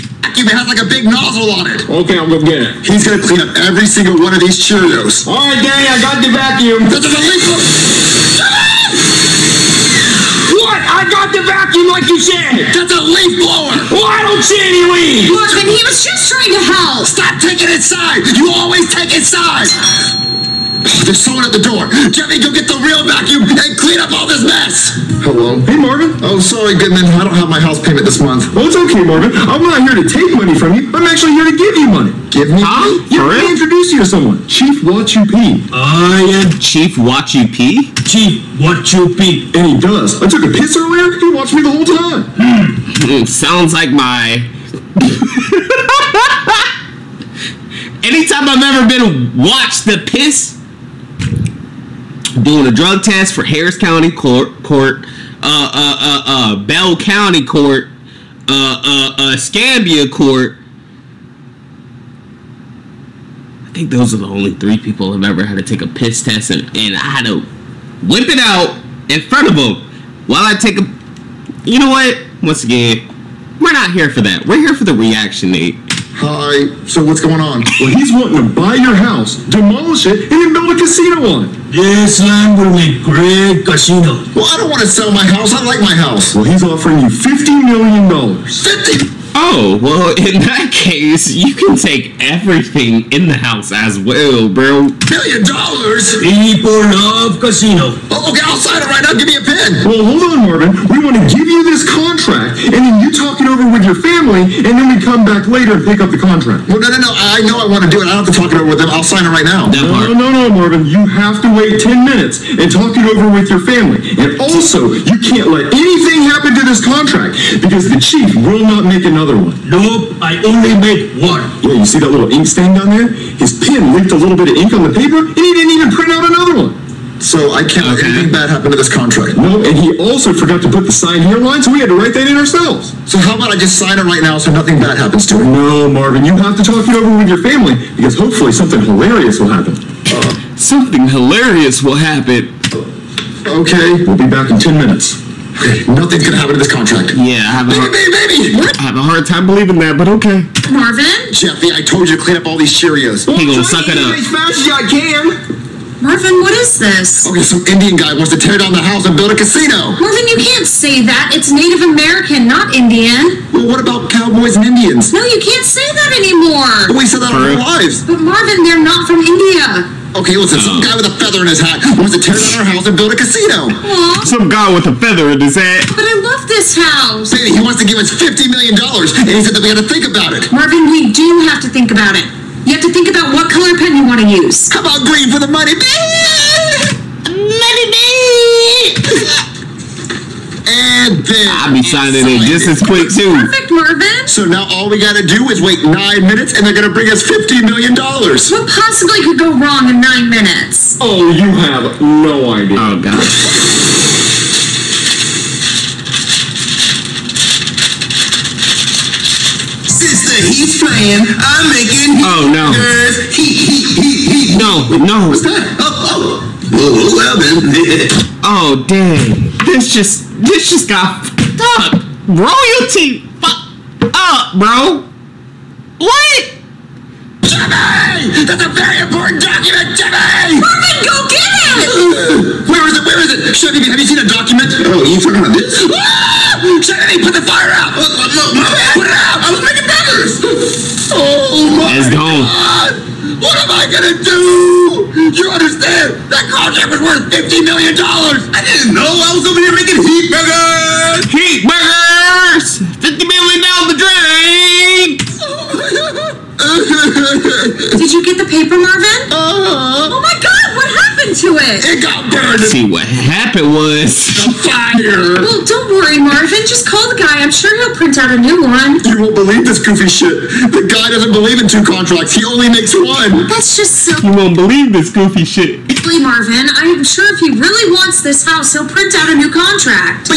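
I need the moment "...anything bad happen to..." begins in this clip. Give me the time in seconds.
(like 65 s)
128 s.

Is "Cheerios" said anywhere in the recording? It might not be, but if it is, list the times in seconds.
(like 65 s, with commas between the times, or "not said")
4 s, 152 s.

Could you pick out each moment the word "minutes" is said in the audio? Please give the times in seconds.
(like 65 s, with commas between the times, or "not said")
112 s, 144 s, 196 s, 200 s.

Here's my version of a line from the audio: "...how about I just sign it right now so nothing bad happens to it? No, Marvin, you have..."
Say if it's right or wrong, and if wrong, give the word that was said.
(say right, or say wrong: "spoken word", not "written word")
right.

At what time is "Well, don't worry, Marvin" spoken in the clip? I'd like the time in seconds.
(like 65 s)
265 s.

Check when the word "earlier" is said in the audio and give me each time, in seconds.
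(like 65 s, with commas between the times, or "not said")
40 s.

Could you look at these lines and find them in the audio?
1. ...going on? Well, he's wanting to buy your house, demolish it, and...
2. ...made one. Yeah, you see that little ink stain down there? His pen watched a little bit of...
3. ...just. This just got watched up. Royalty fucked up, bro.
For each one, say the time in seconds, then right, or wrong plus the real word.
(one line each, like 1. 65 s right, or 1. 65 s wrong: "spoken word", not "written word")
1. 77 s right
2. 120 s wrong: "leaked", not "watched"
3. 219 s wrong: "fucked", not "watched".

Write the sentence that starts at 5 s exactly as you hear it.
All right, Danny, I got the vacuum.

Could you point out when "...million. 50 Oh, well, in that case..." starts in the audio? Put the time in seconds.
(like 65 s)
87 s.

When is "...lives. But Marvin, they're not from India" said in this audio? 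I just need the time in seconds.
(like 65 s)
167 s.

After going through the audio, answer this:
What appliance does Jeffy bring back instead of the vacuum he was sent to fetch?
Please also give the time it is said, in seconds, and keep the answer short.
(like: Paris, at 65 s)
Leaf blower, at 13 s.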